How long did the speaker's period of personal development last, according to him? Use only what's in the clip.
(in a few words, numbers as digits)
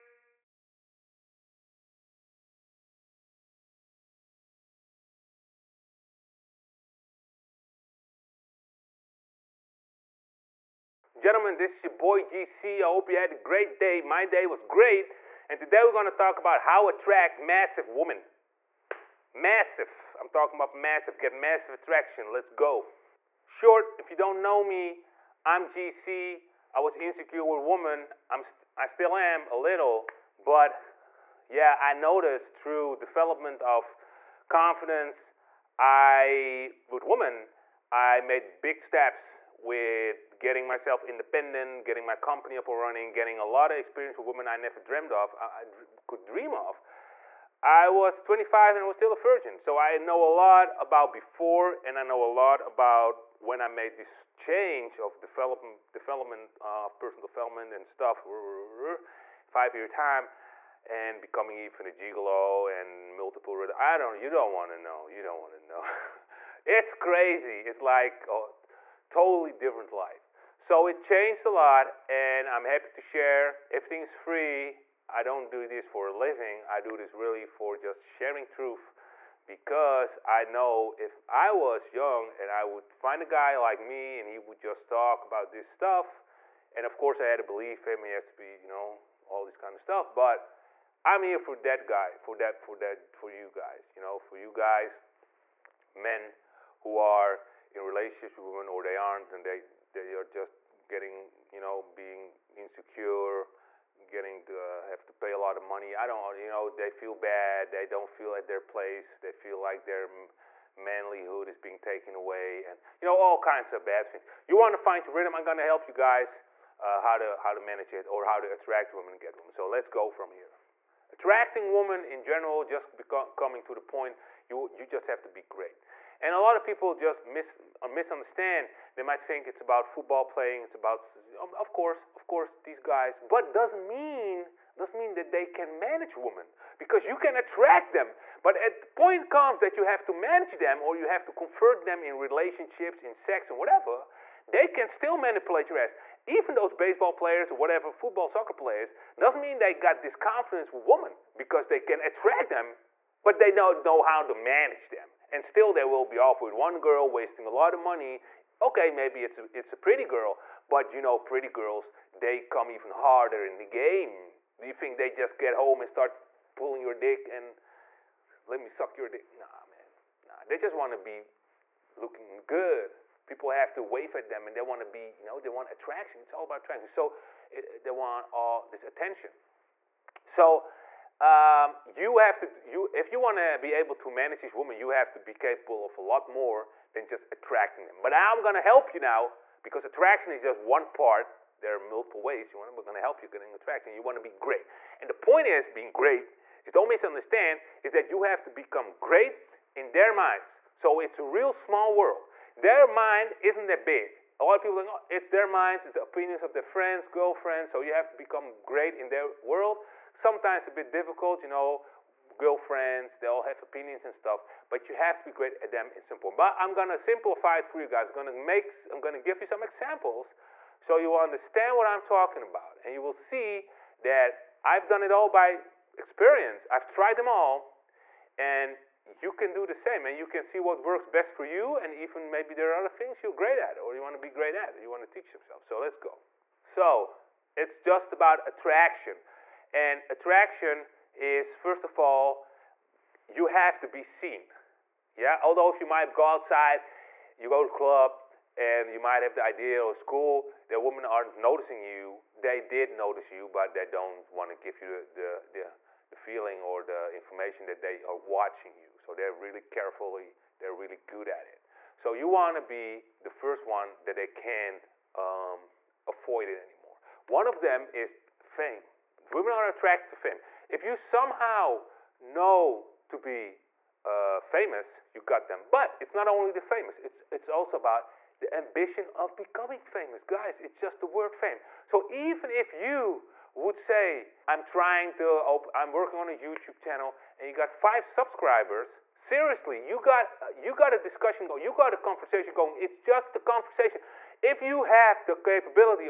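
5 years.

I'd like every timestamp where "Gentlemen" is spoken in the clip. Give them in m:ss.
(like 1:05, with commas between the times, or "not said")
0:11.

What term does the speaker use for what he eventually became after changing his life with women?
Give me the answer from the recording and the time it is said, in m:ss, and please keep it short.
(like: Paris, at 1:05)
gigolo, at 1:01.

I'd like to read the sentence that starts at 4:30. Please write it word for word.
If you somehow know to be uh, famous, you got them.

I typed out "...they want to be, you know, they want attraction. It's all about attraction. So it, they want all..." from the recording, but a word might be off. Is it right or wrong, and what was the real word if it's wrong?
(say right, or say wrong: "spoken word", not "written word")
right.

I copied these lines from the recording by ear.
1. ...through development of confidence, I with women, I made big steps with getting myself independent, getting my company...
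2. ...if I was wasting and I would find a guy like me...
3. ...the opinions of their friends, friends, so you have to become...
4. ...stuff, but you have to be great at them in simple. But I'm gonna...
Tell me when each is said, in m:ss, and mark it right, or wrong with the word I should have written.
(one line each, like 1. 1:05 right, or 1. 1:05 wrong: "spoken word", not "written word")
1. 0:32 right
2. 1:20 wrong: "young", not "wasting"
3. 3:25 wrong: "girlfriends", not "friends"
4. 3:34 right.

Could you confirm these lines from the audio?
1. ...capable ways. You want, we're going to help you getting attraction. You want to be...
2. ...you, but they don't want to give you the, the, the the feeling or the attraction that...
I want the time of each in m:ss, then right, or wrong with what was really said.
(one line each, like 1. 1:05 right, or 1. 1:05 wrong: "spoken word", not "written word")
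1. 3:11 wrong: "multiple", not "capable"
2. 4:13 wrong: "information", not "attraction".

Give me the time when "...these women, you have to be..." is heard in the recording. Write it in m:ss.
3:04.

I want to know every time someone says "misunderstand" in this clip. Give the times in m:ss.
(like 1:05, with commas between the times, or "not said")
2:07, 3:16.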